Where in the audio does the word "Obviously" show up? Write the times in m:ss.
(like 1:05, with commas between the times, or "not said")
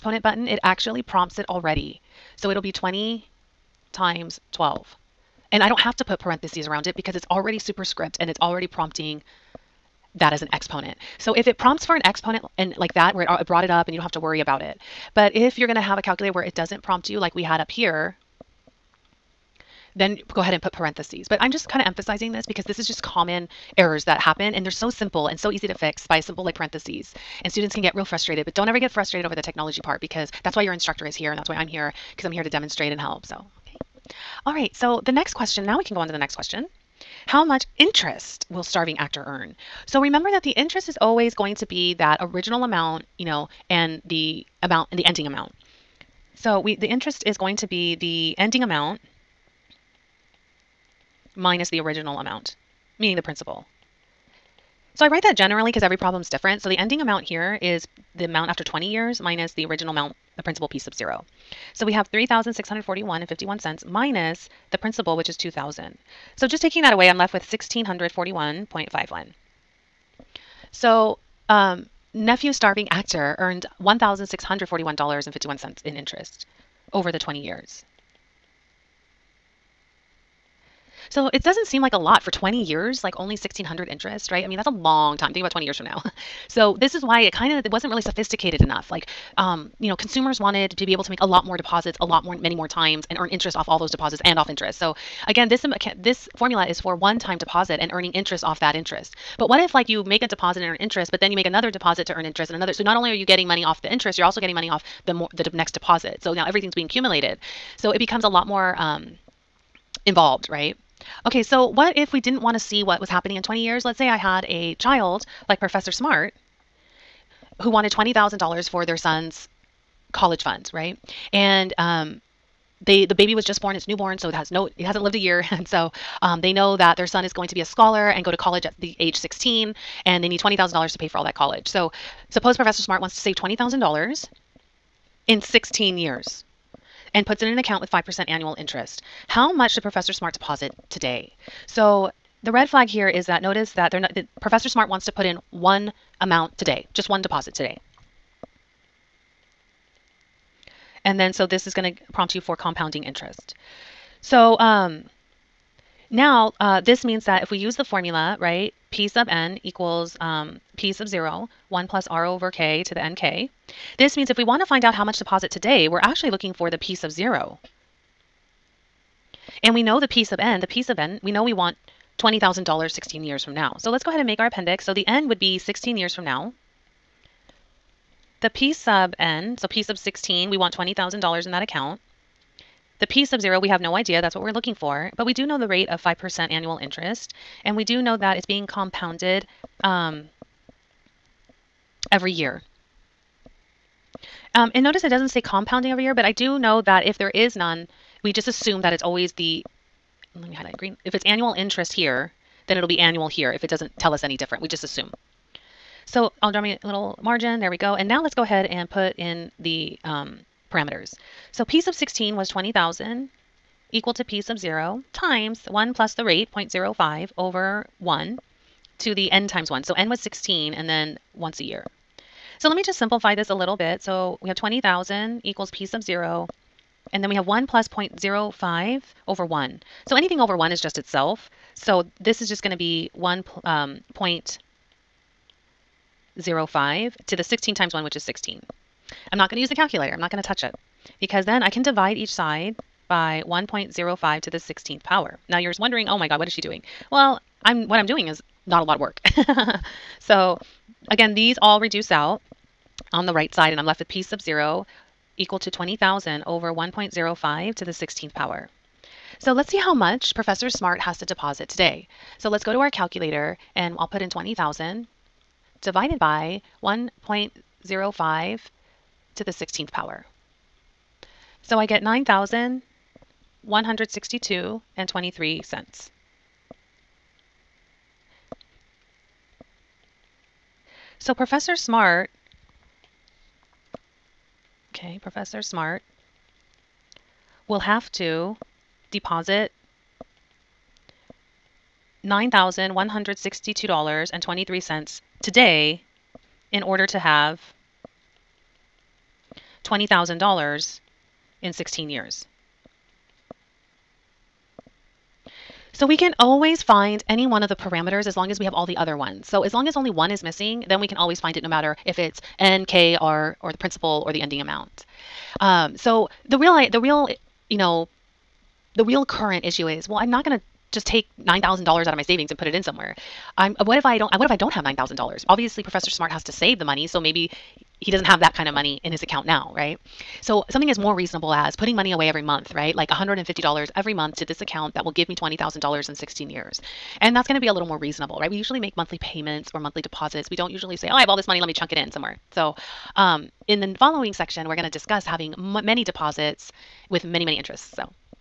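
5:25.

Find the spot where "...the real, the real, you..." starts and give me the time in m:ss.
5:16.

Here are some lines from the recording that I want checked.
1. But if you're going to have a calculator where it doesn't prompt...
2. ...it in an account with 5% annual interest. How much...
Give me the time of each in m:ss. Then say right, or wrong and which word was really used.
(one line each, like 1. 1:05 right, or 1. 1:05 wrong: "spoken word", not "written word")
1. 0:15 right
2. 2:17 right.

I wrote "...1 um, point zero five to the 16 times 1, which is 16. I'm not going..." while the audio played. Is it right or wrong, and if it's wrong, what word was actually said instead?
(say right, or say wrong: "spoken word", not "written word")
right.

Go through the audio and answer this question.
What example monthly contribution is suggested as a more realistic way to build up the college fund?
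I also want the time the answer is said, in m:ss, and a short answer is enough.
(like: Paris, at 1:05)
$150, at 5:33.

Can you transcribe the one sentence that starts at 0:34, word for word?
All right, so the next question, now we can go on to the next question.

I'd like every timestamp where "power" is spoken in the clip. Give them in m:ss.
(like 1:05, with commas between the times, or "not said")
4:05, 4:18, 4:29.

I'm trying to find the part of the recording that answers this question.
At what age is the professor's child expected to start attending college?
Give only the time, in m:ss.
2:08.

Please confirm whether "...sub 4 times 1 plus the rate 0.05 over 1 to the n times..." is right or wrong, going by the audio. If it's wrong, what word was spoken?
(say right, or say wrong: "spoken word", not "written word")
wrong: "0", not "4".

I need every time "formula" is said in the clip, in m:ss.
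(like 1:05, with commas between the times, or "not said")
1:36, 2:37.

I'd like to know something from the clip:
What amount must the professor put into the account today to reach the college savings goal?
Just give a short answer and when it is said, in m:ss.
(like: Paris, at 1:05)
$9,162.23, at 4:32.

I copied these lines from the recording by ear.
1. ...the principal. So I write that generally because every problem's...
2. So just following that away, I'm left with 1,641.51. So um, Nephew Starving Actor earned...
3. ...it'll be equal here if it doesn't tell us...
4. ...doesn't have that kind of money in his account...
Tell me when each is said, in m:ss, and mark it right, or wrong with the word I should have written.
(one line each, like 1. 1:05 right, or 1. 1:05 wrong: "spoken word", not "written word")
1. 0:53 right
2. 1:06 wrong: "taking", not "following"
3. 3:22 wrong: "annual", not "equal"
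4. 5:28 right.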